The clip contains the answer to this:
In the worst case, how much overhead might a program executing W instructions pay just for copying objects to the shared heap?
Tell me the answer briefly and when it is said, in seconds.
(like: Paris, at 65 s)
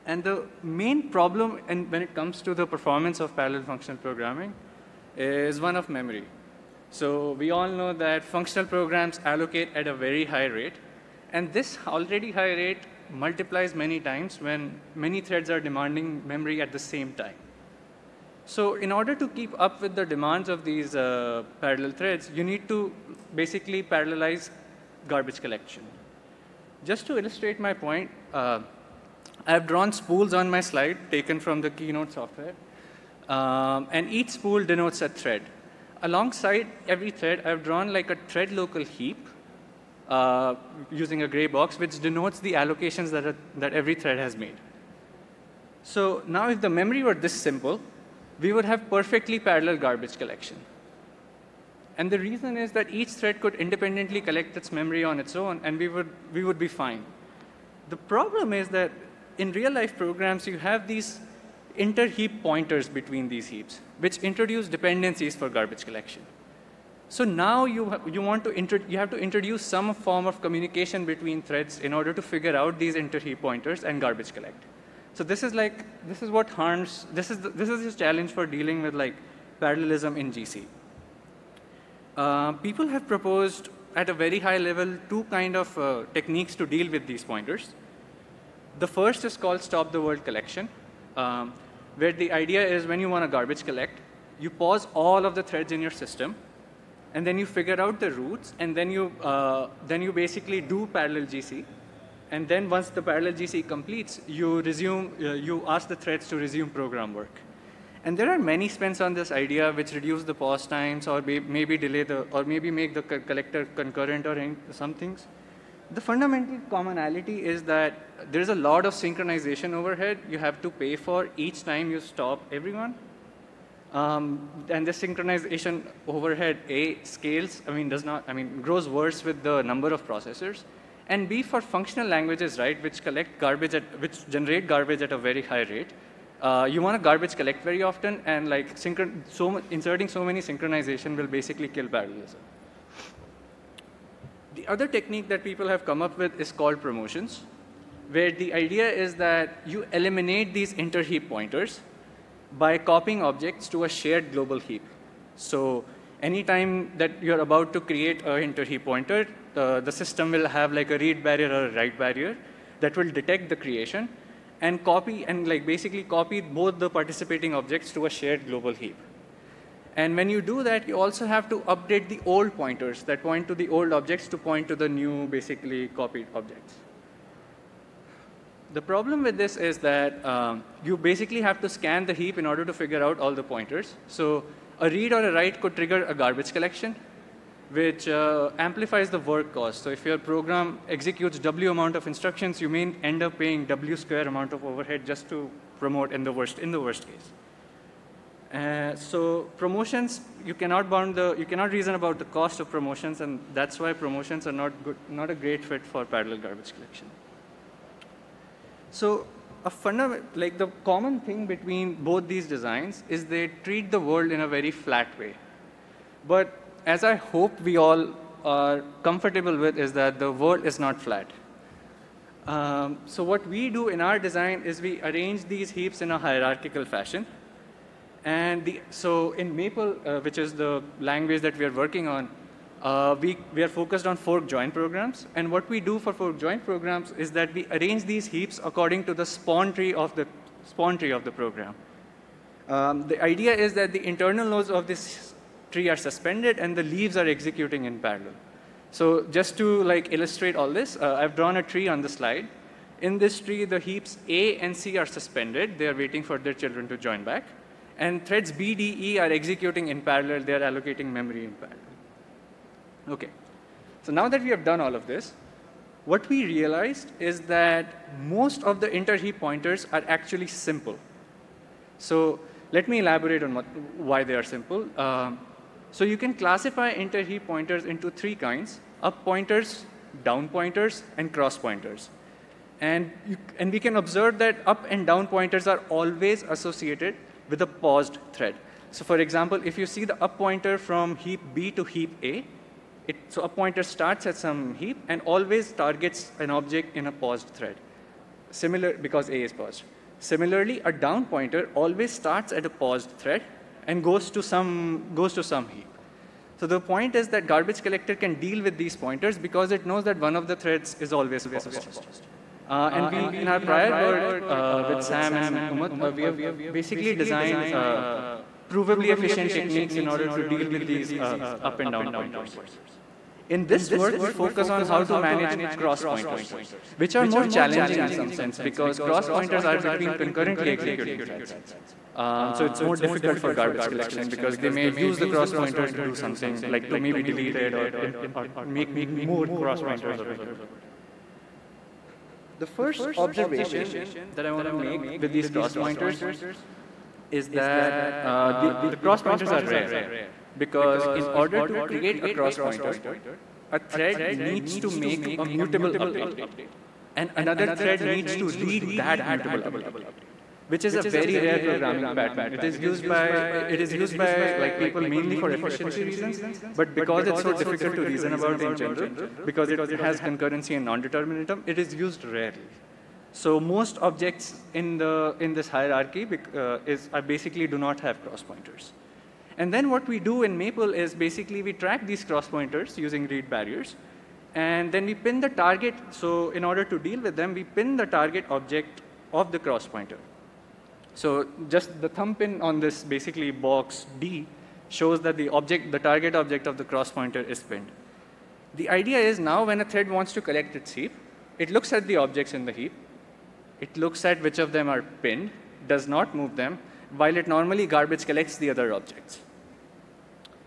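W square, at 193 s.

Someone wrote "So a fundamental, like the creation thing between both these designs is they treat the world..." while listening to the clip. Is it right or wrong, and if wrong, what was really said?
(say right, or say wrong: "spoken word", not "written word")
wrong: "common", not "creation".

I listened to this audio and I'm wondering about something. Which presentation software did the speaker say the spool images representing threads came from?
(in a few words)
Keynote.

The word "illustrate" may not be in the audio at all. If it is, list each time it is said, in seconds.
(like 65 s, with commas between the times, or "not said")
27 s, 250 s.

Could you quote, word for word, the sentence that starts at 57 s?
The problem is that in real-life programs, you have these inter-heap pointers between these heaps, which introduce dependencies for garbage collection.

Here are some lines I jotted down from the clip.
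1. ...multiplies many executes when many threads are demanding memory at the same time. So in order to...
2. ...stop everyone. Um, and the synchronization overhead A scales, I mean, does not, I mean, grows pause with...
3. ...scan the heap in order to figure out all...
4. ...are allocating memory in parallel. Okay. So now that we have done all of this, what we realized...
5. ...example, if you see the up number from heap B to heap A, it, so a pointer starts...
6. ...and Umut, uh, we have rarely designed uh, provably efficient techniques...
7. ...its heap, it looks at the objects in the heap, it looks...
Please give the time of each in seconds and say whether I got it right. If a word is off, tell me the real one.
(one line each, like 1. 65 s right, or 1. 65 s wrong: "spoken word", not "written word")
1. 13 s wrong: "times", not "executes"
2. 121 s wrong: "worse", not "pause"
3. 181 s right
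4. 260 s right
5. 289 s wrong: "pointer", not "number"
6. 315 s wrong: "basically", not "rarely"
7. 400 s right.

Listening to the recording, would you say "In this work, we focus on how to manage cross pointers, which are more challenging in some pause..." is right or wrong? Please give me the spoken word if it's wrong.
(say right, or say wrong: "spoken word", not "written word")
wrong: "sense", not "pause".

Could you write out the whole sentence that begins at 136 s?
Uh, you want to garbage collect very often, and like synchron so inserting so many synchronization will basically kill parallelism.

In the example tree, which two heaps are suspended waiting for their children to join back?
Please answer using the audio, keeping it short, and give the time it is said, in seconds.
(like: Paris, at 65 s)
A and C, at 254 s.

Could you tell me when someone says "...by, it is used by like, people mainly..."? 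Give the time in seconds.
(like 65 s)
363 s.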